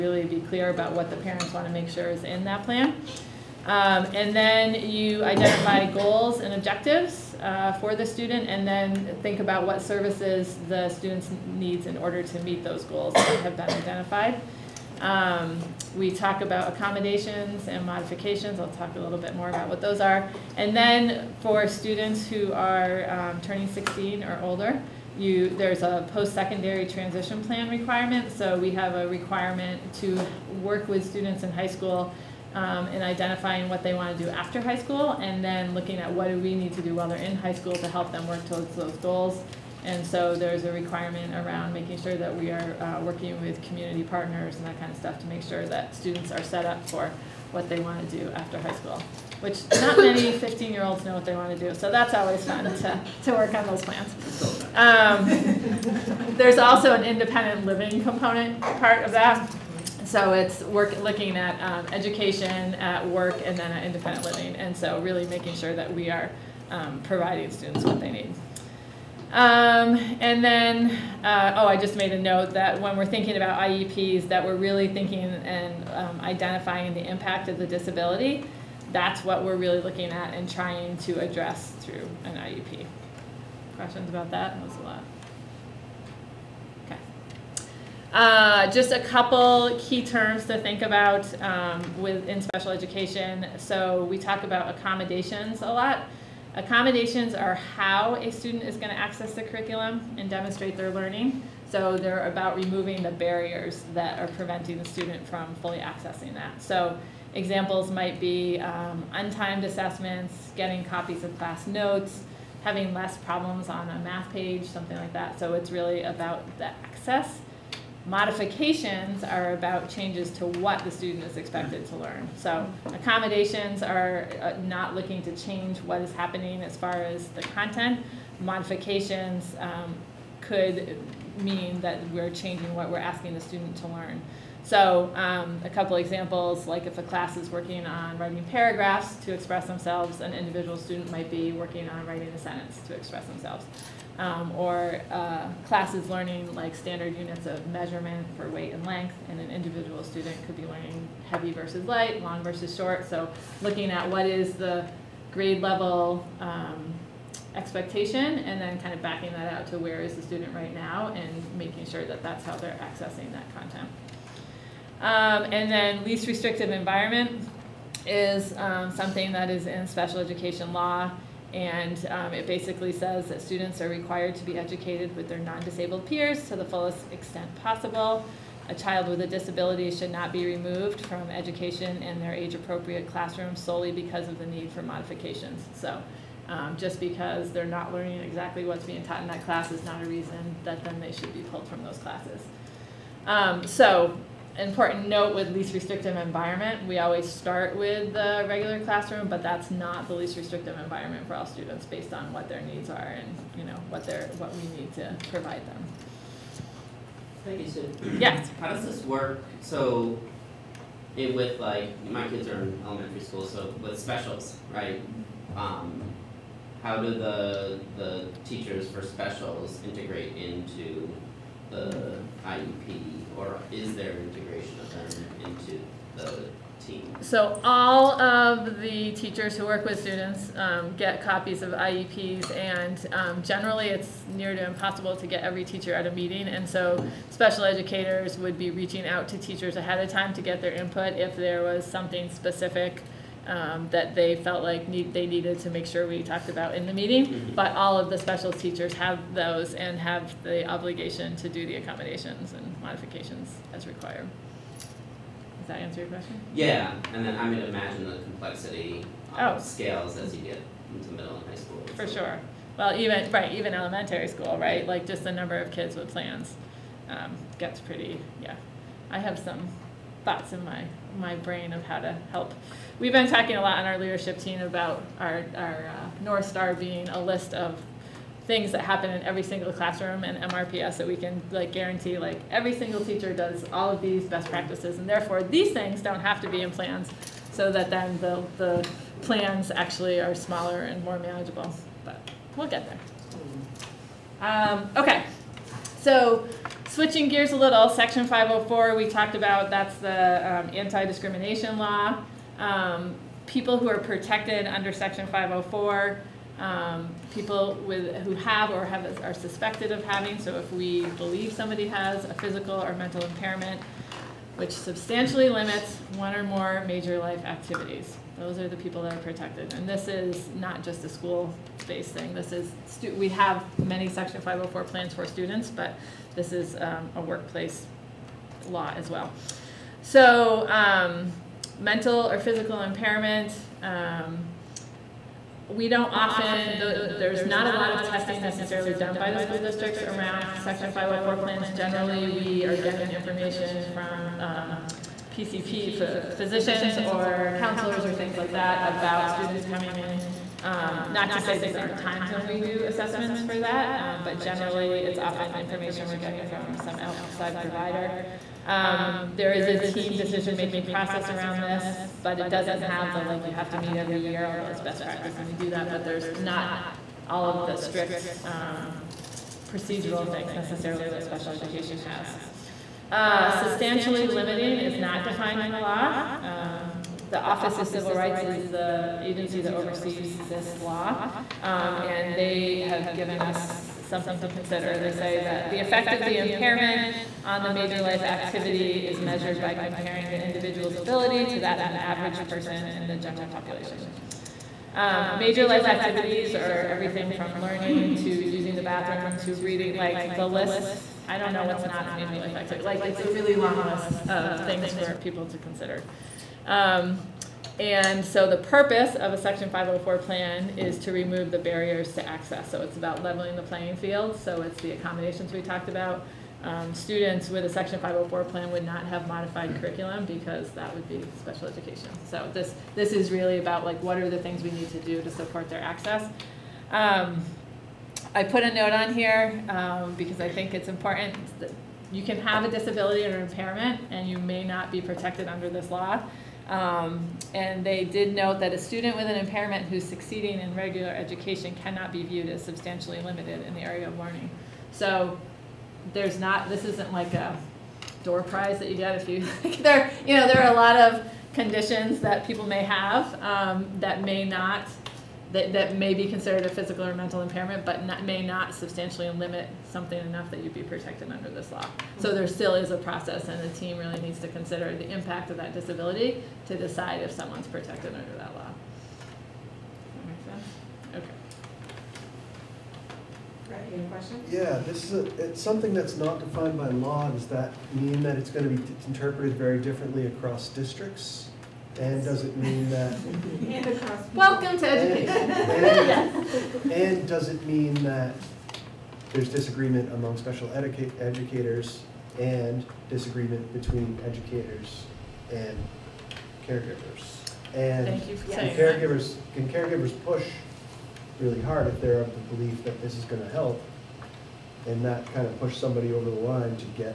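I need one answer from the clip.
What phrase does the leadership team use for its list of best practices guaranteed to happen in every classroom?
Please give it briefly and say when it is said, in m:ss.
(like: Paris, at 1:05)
North Star, at 4:36.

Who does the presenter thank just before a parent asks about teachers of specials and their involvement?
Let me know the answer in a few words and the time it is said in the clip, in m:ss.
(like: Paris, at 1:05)
Sue, at 3:27.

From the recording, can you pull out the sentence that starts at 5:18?
Those are the people that are protected.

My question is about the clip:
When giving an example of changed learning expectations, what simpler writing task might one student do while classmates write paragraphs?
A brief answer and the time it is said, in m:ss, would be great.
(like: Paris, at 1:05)
writing a sentence, at 2:22.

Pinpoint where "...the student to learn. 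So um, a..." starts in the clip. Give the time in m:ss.
2:13.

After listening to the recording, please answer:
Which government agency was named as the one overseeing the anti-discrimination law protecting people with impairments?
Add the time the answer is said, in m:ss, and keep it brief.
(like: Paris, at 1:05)
Office of Civil Rights, at 6:17.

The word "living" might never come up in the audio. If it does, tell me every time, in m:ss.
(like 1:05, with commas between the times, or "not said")
0:57, 1:04.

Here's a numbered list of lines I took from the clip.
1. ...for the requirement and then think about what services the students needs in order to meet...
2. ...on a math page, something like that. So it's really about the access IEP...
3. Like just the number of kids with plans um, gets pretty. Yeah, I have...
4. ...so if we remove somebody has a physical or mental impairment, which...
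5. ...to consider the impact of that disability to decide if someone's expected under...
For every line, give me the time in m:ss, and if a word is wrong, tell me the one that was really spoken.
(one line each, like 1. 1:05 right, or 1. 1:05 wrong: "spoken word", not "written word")
1. 0:07 wrong: "student", not "requirement"
2. 1:53 wrong: "Modifications", not "IEP"
3. 4:24 right
4. 5:10 wrong: "believe", not "remove"
5. 7:44 wrong: "protected", not "expected".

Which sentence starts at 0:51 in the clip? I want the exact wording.
So that's always fun to, to work on those plans.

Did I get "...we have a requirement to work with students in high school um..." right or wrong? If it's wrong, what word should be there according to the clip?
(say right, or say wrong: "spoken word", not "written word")
right.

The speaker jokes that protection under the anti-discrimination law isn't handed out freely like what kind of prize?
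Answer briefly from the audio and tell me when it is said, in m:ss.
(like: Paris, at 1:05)
door prize, at 7:28.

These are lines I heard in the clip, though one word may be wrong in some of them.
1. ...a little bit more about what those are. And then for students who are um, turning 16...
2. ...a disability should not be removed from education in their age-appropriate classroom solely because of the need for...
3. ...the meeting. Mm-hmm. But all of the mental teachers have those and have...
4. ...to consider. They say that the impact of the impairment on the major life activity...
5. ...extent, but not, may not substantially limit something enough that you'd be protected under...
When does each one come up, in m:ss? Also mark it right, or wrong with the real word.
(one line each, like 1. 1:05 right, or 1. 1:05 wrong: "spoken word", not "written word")
1. 0:18 right
2. 2:59 right
3. 4:06 wrong: "special", not "mental"
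4. 6:24 wrong: "effect", not "impact"
5. 7:37 wrong: "impairment", not "extent".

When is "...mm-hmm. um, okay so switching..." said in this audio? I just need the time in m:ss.
4:53.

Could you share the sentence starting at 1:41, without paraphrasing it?
So they're about removing the barriers that are preventing the student from fully accessing that.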